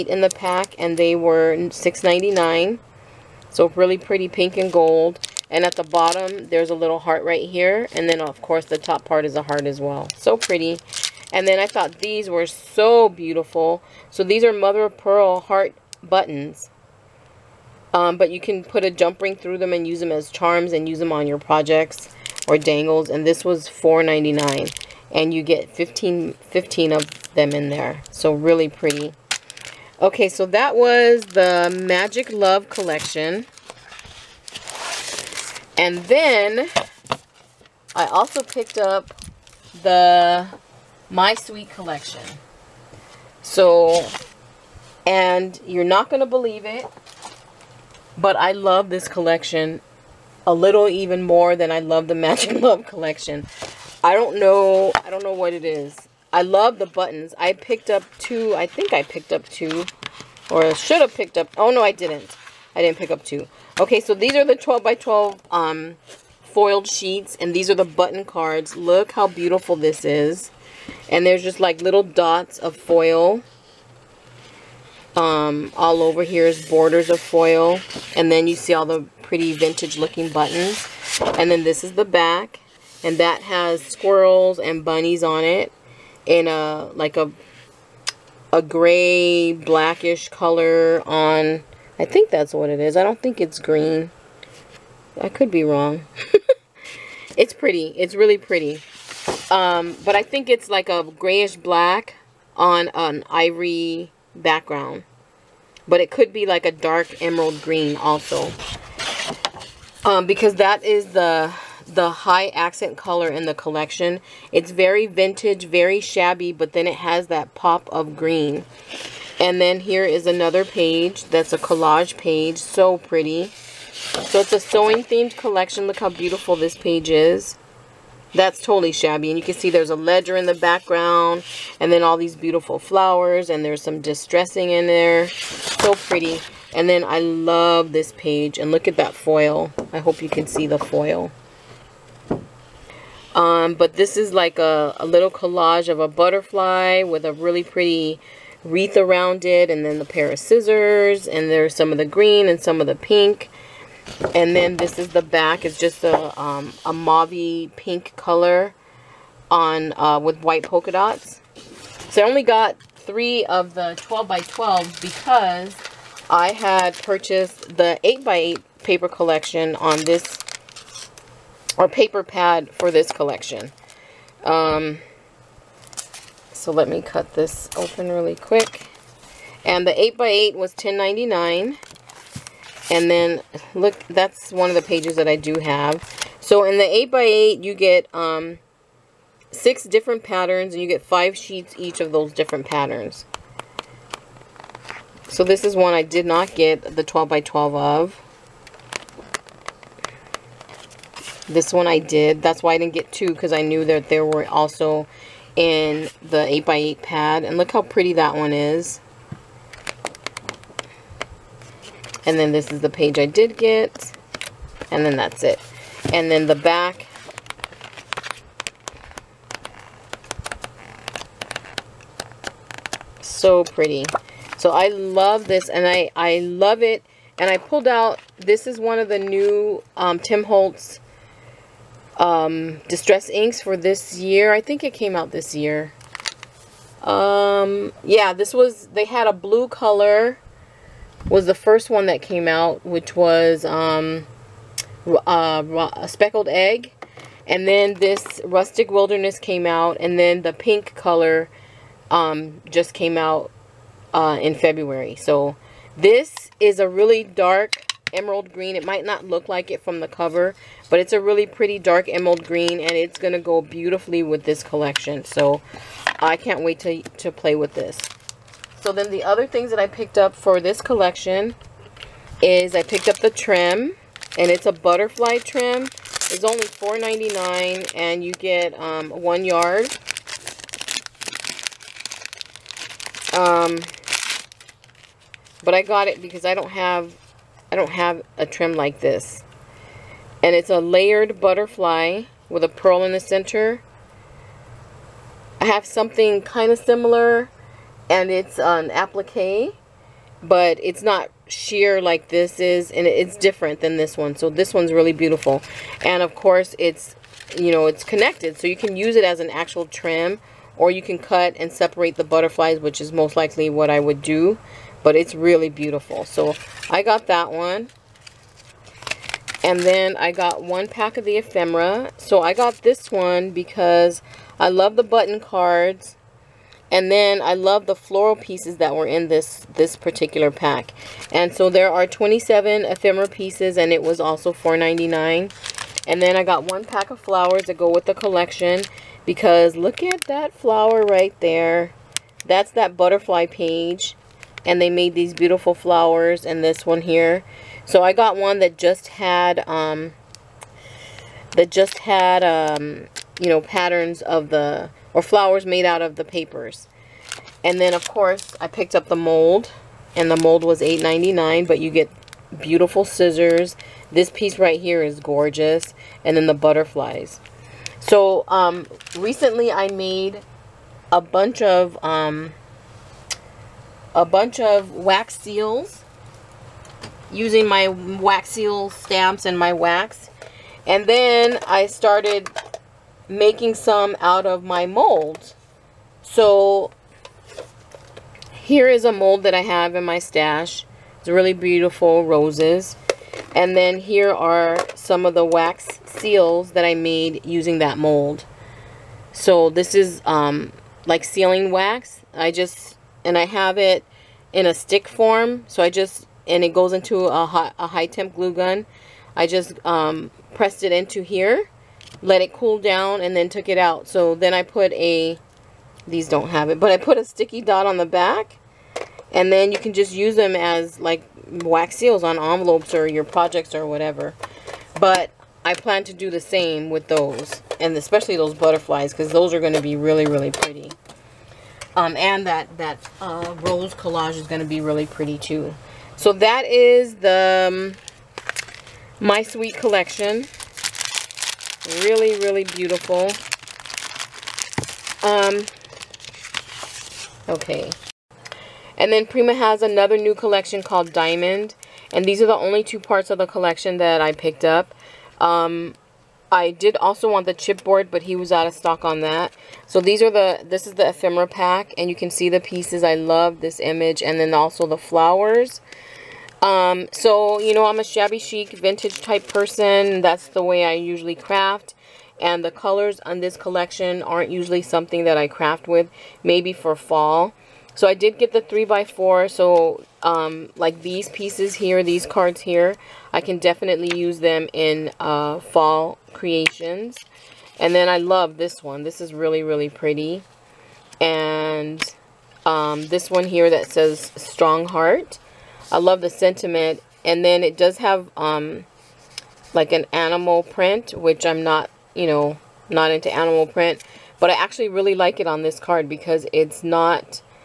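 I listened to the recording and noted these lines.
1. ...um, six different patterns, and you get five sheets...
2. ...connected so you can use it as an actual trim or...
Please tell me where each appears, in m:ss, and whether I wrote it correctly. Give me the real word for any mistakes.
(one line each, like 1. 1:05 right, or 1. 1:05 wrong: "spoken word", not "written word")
1. 3:08 right
2. 5:08 right.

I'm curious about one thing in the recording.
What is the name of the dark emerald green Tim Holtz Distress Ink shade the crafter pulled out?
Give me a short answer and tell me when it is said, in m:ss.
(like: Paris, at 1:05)
Rustic Wilderness, at 4:08.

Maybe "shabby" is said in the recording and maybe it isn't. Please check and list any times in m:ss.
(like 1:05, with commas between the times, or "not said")
1:56, 2:08, 7:48.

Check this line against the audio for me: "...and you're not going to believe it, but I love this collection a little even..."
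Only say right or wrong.
right.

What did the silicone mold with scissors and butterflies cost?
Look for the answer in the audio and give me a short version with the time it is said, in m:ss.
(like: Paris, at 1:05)
$8.99, at 6:00.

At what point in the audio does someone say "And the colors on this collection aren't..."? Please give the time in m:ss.
7:52.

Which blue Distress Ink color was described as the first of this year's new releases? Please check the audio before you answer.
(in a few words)
Speckled Egg.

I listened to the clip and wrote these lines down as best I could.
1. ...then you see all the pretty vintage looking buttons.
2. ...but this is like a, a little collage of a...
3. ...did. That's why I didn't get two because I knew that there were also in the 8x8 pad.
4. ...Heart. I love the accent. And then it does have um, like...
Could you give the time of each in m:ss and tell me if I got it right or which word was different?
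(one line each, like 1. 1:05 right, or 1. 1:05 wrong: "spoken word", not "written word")
1. 1:18 right
2. 2:23 right
3. 3:21 right
4. 8:14 wrong: "sentiment", not "accent".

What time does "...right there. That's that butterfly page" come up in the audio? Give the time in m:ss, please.
5:41.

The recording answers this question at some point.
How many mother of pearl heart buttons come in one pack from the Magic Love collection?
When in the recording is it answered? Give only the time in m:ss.
0:26.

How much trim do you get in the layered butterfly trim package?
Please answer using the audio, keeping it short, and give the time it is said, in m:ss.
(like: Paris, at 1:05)
one yard, at 4:39.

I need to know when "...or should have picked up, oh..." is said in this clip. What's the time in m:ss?
1:00.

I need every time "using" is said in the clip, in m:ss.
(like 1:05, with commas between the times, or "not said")
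6:17, 6:37.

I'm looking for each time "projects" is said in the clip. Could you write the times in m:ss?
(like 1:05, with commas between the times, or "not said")
0:21, 7:03.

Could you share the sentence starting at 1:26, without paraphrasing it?
In a, like a, a gray blackish color on I think that's what it is.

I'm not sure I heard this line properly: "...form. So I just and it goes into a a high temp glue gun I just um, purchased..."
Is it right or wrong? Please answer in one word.
wrong.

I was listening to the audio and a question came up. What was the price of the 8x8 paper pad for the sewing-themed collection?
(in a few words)
$10.99.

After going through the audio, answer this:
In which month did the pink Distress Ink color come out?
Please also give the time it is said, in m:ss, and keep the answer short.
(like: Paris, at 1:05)
February, at 4:14.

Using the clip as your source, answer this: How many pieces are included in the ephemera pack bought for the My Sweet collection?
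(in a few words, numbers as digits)
27.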